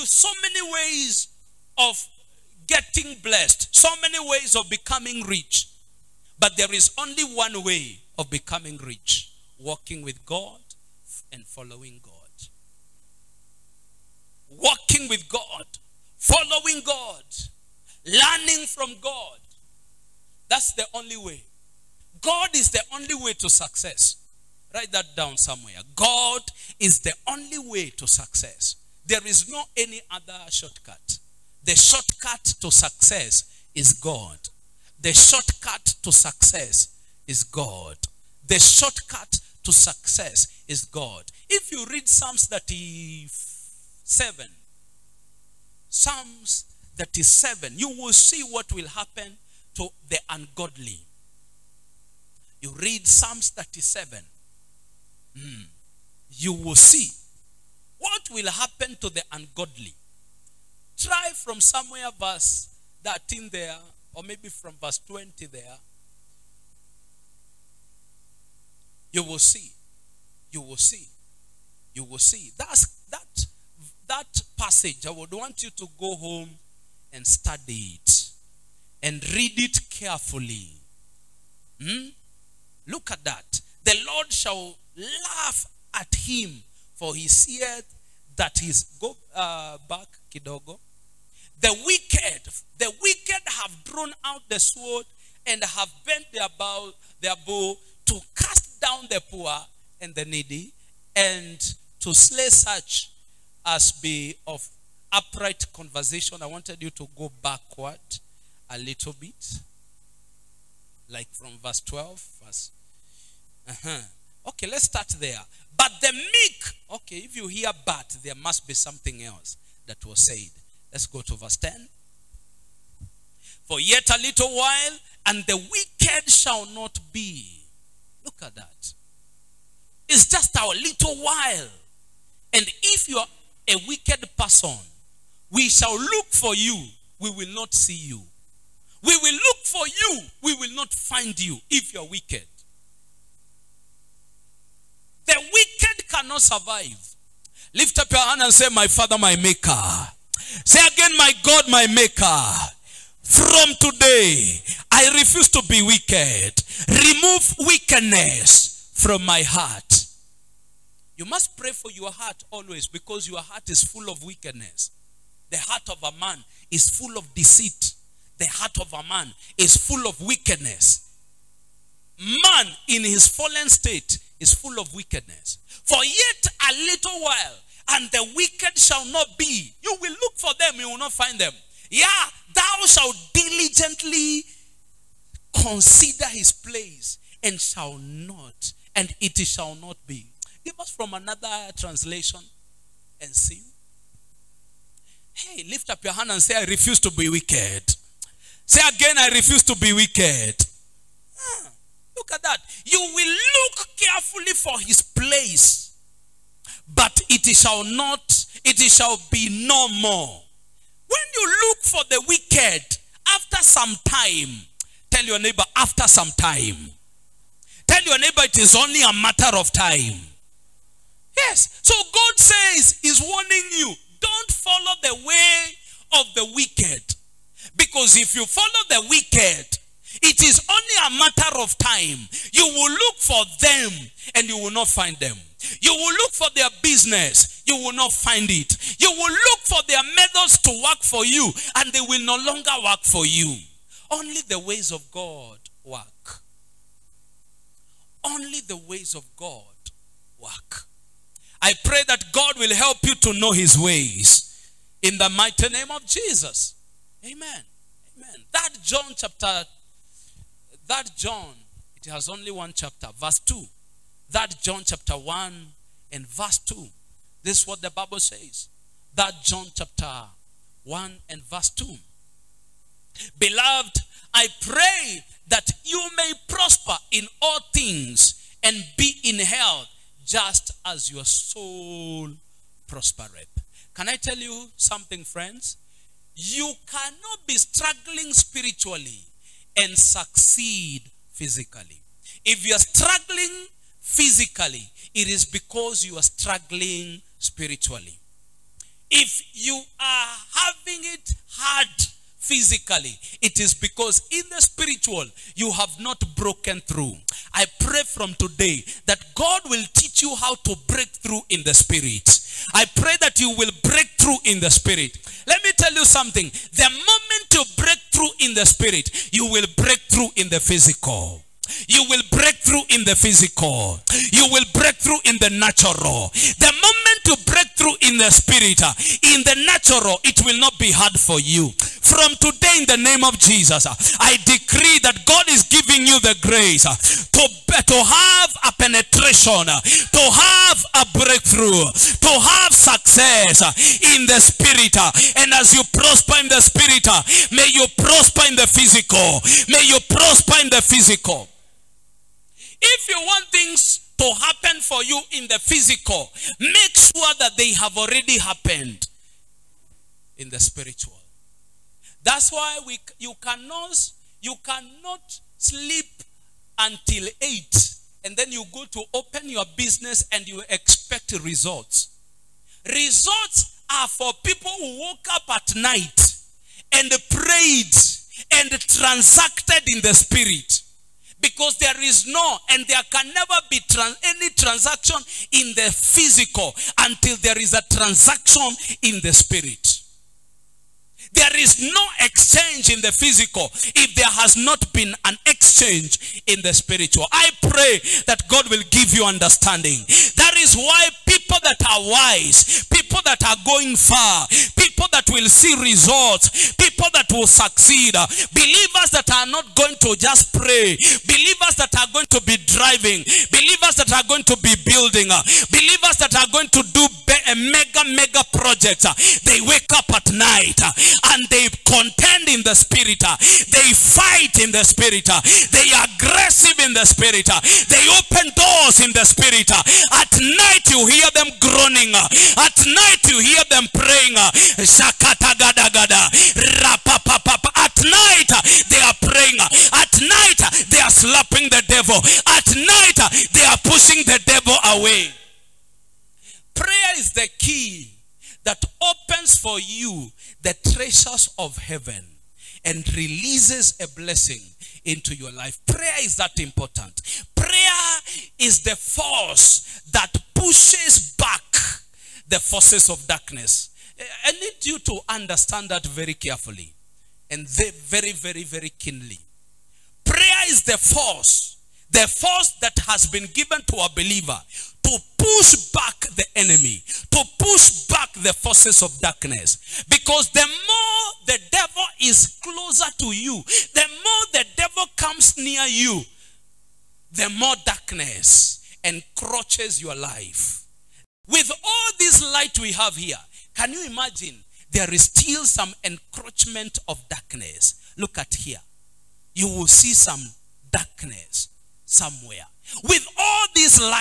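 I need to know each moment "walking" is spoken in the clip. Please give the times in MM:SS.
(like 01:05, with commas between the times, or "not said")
00:09, 00:14.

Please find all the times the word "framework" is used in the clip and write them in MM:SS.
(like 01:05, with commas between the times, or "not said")
not said.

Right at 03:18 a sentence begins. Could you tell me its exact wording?
Say again, I refuse to be wicked.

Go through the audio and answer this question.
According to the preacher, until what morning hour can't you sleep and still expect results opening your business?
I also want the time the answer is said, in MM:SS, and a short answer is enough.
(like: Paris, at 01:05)
8, at 06:06.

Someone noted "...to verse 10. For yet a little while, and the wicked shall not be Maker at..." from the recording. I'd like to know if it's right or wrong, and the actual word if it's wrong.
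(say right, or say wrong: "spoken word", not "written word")
wrong: "Look", not "Maker".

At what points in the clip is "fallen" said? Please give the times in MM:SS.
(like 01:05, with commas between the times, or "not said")
02:53.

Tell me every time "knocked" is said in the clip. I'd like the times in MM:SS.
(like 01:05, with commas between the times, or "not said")
not said.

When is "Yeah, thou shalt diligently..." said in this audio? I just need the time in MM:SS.
03:01.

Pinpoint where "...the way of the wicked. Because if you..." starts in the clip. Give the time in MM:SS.
03:45.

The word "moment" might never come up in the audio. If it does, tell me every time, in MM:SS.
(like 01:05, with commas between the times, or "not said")
05:16, 05:26.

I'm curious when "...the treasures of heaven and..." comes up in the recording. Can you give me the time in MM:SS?
07:30.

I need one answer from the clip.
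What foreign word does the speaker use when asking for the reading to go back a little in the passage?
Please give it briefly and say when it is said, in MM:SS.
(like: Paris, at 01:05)
kidogo, at 01:30.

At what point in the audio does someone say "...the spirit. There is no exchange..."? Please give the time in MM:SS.
06:29.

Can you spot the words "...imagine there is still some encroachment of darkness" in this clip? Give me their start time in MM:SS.
08:14.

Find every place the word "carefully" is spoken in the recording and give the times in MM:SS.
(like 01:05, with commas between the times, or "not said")
01:19, 03:23, 07:46.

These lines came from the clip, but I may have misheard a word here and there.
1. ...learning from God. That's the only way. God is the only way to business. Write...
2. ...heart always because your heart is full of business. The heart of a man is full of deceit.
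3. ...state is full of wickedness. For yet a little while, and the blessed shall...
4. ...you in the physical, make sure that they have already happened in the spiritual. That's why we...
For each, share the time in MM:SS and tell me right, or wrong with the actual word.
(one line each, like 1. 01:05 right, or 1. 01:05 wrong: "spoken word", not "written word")
1. 00:18 wrong: "success", not "business"
2. 02:42 wrong: "wickedness", not "business"
3. 02:53 wrong: "wicked", not "blessed"
4. 05:55 right.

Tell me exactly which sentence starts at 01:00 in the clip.
Try from somewhere verse 13 there, or maybe from verse 20 there, You will see.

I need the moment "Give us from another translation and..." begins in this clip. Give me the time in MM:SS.
03:10.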